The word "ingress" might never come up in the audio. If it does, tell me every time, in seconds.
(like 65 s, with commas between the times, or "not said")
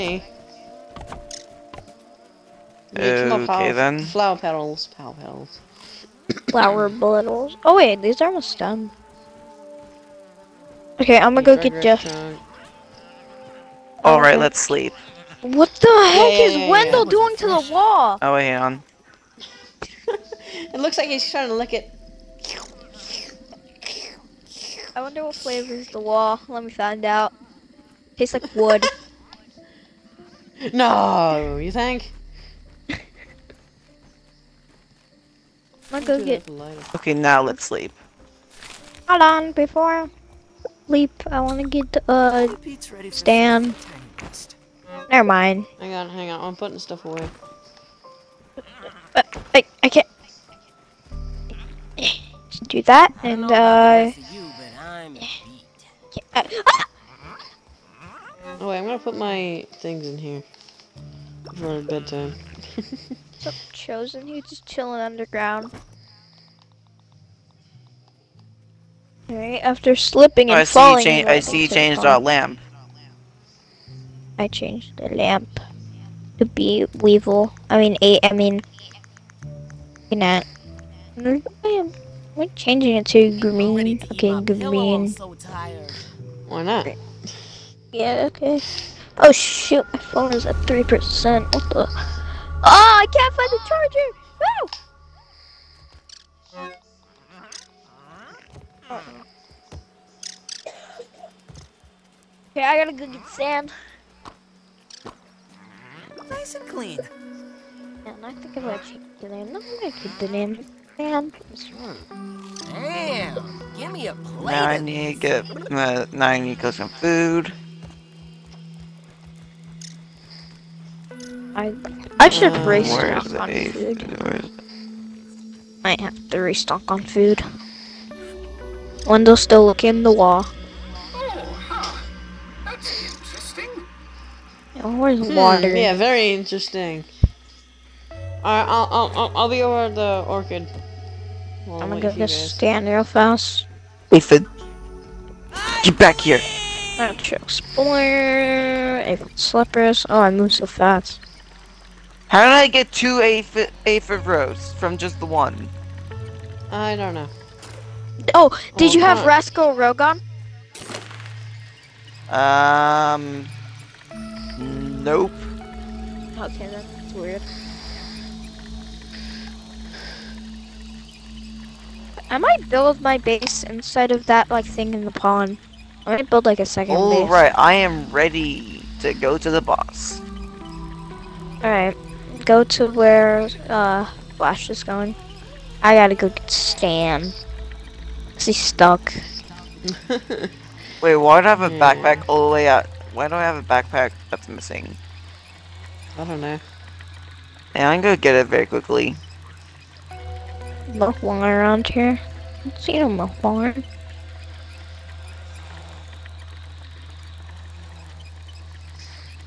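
not said.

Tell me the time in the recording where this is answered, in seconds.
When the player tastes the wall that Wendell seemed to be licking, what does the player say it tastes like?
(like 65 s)
28 s.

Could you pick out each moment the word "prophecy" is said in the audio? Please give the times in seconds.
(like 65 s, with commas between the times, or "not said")
not said.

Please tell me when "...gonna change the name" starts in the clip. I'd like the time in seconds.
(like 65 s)
108 s.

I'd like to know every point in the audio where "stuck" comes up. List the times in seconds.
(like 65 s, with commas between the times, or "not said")
188 s.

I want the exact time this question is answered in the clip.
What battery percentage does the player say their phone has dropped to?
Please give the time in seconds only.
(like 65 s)
90 s.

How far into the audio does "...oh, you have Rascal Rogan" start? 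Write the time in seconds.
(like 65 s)
158 s.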